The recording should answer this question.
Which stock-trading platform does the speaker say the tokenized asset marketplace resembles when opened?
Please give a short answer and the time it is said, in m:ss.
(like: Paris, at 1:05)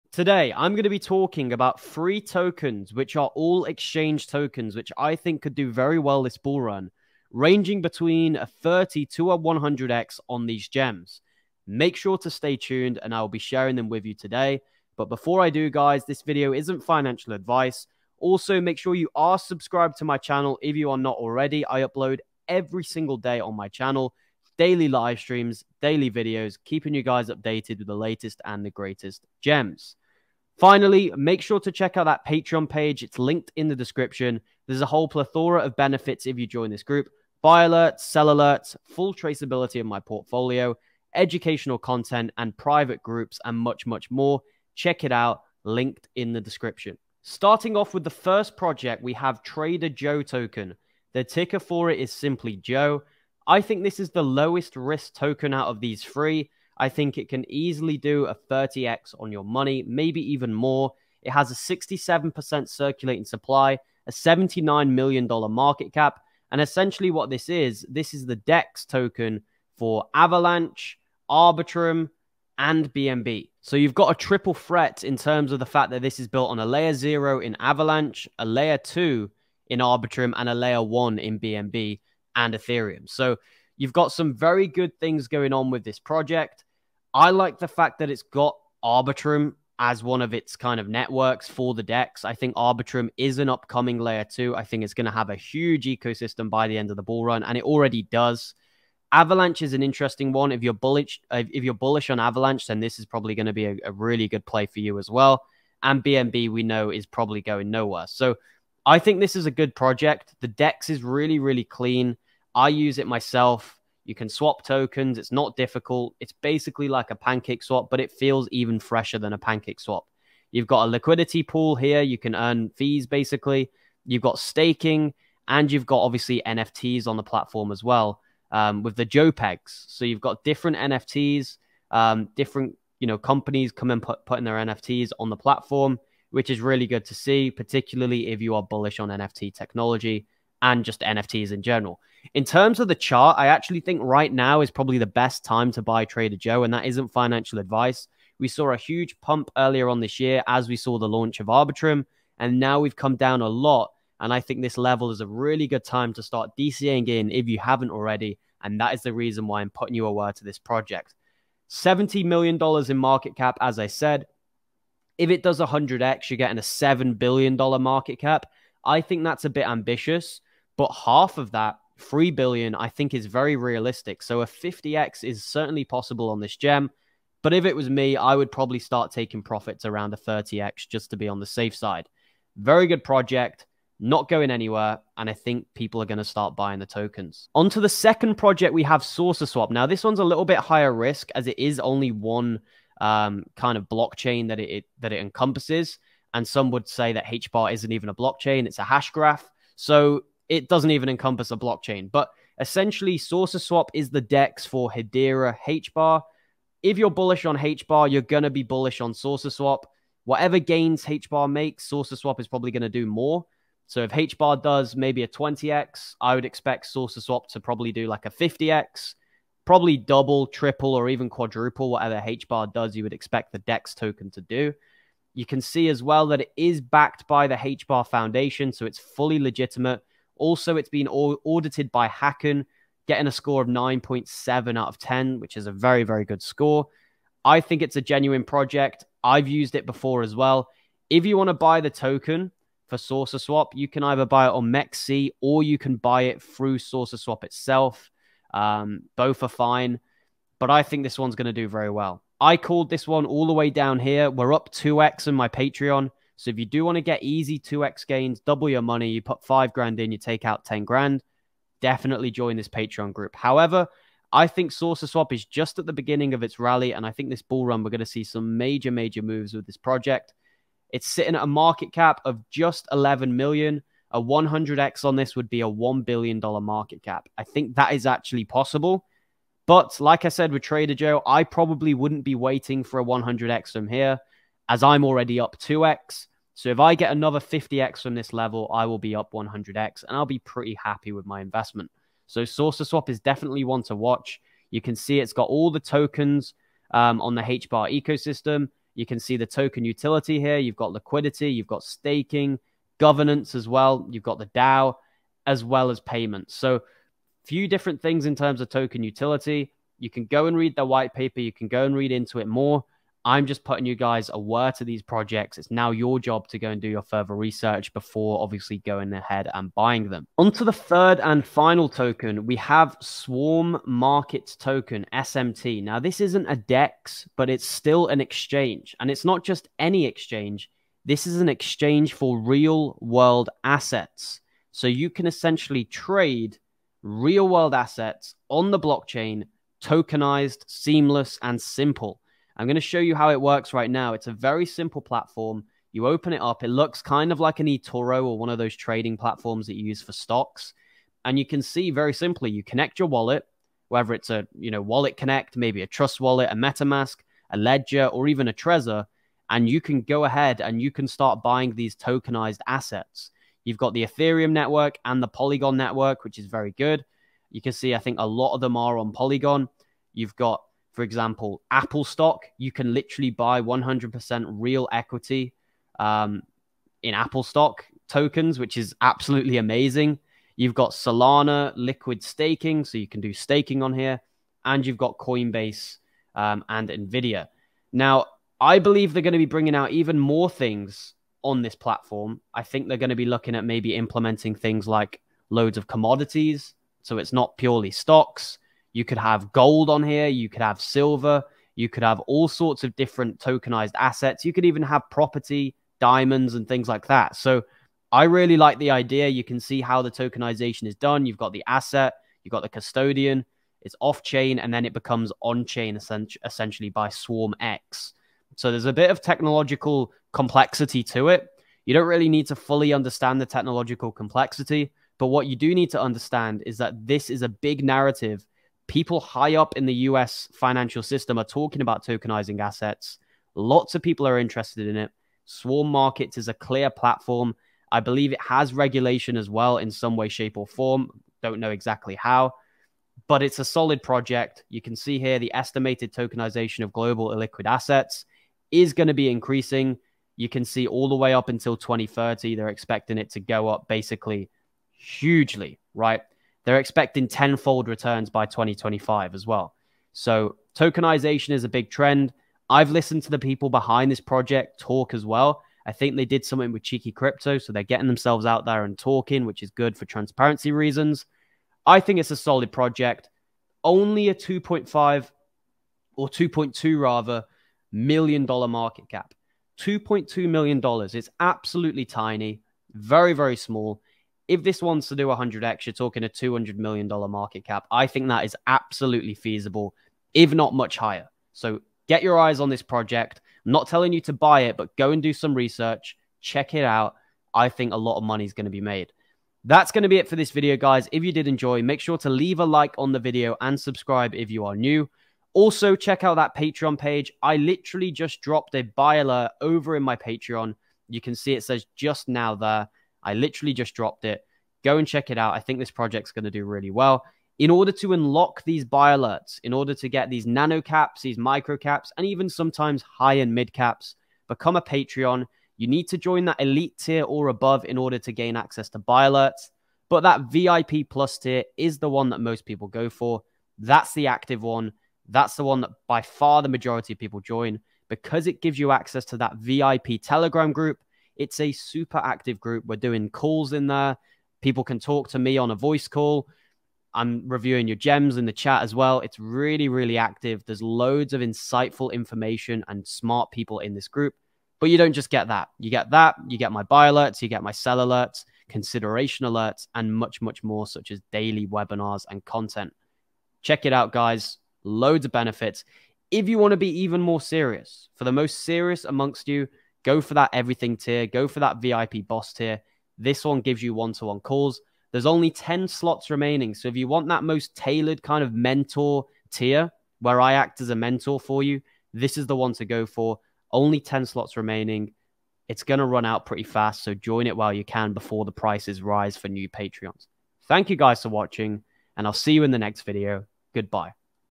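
eToro, at 5:47.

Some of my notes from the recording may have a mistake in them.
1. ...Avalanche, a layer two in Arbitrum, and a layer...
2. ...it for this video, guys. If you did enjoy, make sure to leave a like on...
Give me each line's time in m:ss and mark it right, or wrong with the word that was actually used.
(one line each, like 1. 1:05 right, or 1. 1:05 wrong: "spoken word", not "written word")
1. 1:17 right
2. 8:20 right.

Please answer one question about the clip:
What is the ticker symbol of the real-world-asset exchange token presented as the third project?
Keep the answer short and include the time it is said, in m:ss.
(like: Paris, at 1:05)
SMT, at 5:25.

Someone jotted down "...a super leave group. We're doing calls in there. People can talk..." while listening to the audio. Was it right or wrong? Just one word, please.
wrong.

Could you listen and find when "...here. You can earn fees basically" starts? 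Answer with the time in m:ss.
2:01.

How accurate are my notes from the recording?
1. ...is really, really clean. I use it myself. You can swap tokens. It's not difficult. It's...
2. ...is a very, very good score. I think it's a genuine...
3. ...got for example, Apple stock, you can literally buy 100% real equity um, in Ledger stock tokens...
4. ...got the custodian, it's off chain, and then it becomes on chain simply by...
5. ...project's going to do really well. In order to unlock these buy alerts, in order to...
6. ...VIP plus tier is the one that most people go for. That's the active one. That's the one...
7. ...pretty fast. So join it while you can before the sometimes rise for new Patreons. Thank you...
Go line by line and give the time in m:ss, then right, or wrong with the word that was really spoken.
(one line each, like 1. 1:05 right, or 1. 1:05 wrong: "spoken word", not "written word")
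1. 1:50 right
2. 3:55 right
3. 6:10 wrong: "Apple", not "Ledger"
4. 6:52 wrong: "essentially", not "simply"
5. 8:35 right
6. 8:50 right
7. 9:46 wrong: "prices", not "sometimes".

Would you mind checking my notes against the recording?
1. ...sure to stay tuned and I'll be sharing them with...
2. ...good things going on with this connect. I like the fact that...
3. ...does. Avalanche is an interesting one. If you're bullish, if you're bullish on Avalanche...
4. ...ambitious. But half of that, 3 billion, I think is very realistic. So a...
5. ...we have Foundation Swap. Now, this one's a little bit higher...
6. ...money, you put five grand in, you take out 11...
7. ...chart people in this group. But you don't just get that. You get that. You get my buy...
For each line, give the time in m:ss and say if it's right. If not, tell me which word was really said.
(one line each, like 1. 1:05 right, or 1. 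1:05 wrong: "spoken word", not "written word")
1. 0:11 right
2. 1:24 wrong: "project", not "connect"
3. 1:38 right
4. 2:49 right
5. 3:08 wrong: "Saucer", not "Foundation"
6. 4:18 wrong: "10", not "11"
7. 9:13 wrong: "smart", not "chart".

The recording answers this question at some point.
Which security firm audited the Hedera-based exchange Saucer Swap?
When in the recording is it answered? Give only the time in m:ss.
3:52.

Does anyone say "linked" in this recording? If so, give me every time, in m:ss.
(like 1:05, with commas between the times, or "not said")
0:33, 0:45.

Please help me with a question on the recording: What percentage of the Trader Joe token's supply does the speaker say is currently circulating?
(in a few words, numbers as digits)
67%.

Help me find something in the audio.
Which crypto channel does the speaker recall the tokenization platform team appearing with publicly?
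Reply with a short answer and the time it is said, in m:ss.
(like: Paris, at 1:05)
Cheeky Crypto, at 7:46.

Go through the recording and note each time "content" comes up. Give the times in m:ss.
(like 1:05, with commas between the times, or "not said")
0:41, 9:22.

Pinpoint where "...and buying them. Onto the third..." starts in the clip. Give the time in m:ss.
5:19.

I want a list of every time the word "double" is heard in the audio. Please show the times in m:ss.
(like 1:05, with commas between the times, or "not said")
3:39, 4:18.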